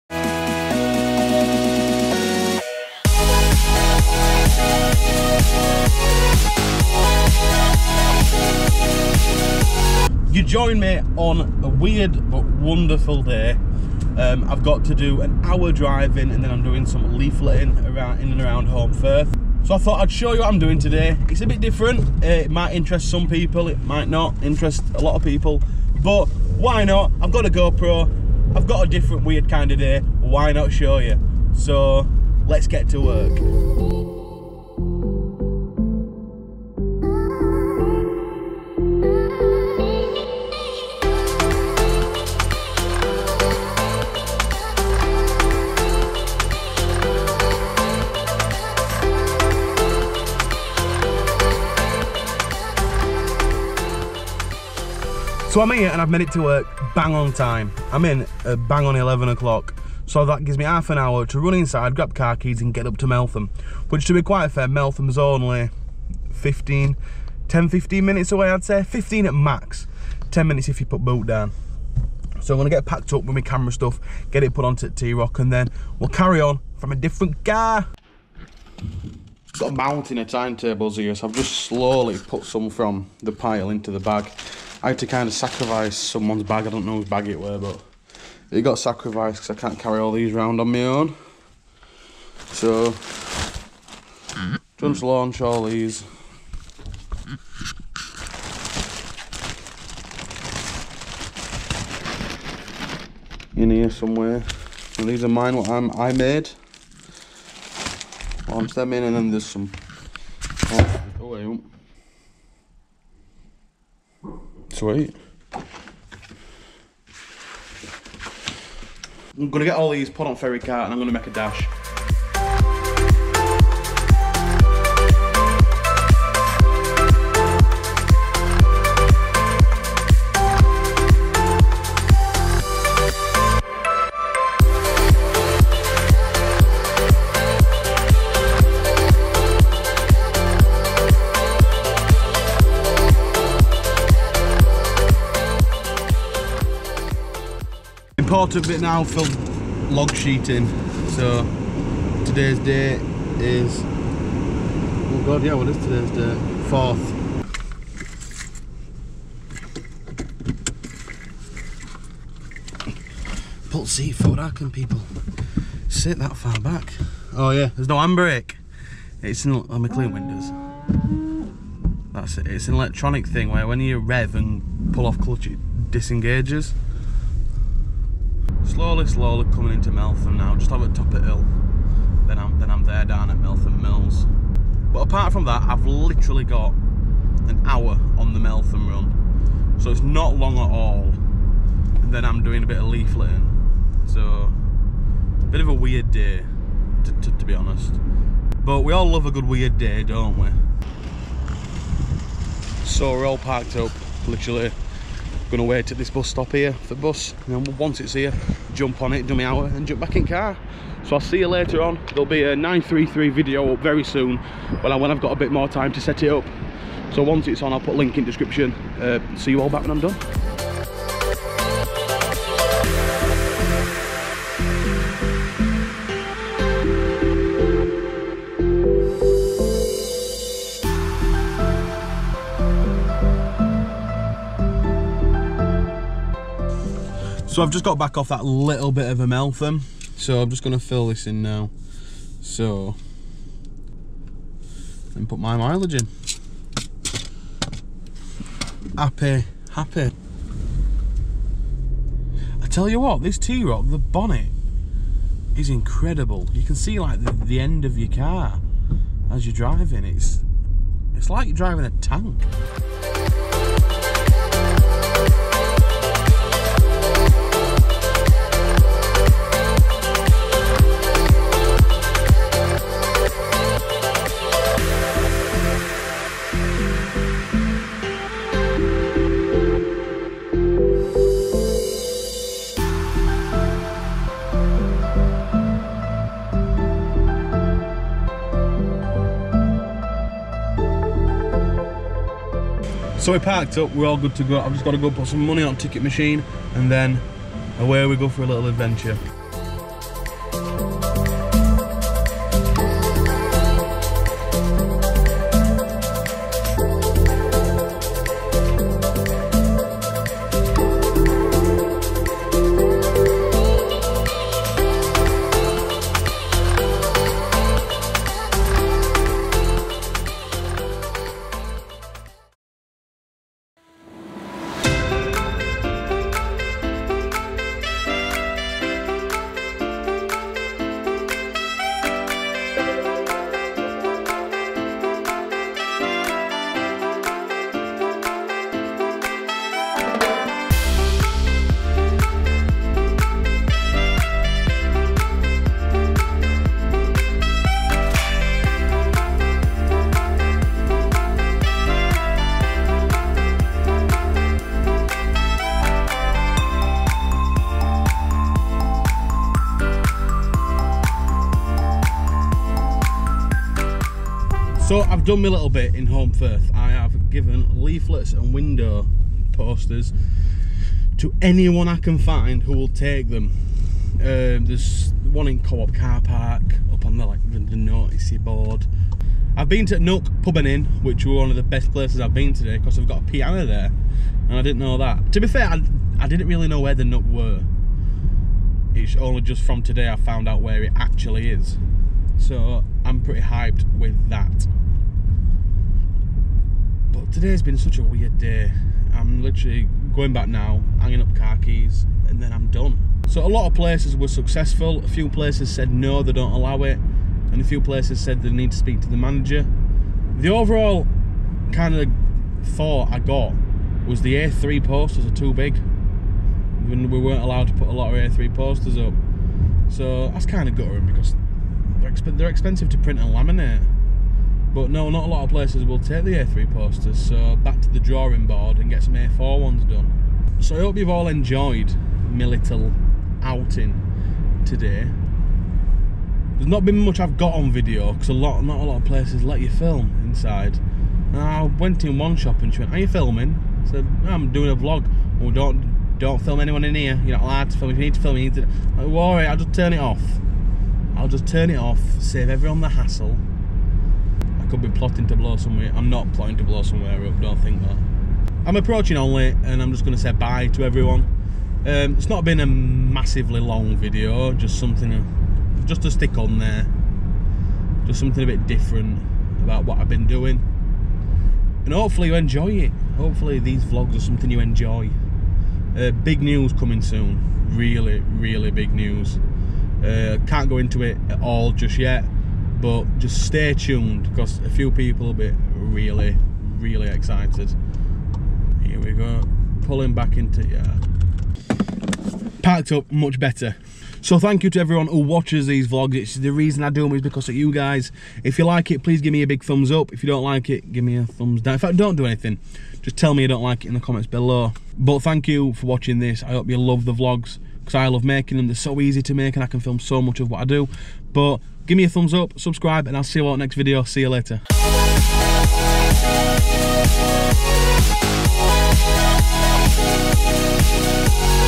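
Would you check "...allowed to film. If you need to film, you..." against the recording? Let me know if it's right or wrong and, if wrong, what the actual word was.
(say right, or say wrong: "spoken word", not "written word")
right.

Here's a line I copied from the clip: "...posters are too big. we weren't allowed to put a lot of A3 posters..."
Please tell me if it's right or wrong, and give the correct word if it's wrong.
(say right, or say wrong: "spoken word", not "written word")
right.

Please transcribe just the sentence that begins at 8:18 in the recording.
If you like it, please give me a big thumbs up.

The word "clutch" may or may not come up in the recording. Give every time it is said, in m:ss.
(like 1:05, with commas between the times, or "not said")
2:55.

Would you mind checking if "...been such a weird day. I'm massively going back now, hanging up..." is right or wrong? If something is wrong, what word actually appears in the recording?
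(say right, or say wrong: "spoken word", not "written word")
wrong: "literally", not "massively".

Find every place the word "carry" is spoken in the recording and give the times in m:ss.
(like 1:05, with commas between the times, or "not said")
1:16, 1:29.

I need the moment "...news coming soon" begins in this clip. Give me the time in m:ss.
7:56.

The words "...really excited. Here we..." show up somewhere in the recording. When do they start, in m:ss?
8:06.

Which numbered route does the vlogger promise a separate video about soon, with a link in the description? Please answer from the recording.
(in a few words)
933.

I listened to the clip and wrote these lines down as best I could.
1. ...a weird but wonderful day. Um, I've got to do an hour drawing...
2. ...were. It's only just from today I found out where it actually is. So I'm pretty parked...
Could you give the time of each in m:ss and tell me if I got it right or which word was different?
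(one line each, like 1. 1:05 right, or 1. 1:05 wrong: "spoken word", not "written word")
1. 0:11 wrong: "driving", not "drawing"
2. 6:27 wrong: "hyped", not "parked".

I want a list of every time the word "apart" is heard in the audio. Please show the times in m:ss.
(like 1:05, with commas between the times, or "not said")
3:05.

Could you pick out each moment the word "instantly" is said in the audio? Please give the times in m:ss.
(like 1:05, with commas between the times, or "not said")
not said.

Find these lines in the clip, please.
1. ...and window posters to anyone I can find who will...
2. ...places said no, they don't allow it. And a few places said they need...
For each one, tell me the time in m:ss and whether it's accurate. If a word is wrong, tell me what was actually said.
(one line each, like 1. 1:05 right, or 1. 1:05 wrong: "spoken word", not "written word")
1. 6:08 right
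2. 6:45 right.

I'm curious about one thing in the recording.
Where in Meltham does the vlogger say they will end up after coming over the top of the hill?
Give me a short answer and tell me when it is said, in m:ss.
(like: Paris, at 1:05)
Meltham Mills, at 3:03.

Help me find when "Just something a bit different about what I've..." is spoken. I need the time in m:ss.
7:48.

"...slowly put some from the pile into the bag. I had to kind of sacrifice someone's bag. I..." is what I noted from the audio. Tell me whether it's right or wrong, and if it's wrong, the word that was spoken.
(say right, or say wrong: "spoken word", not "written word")
right.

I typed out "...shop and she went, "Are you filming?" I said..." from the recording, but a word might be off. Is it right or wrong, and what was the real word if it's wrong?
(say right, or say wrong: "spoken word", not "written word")
right.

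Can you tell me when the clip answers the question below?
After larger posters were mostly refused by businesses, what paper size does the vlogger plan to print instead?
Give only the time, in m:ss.
7:09.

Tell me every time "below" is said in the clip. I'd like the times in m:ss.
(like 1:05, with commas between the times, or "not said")
8:24.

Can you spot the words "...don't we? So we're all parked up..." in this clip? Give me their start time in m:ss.
3:20.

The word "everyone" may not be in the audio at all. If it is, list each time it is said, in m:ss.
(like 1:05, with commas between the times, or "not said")
7:32, 7:40, 8:14.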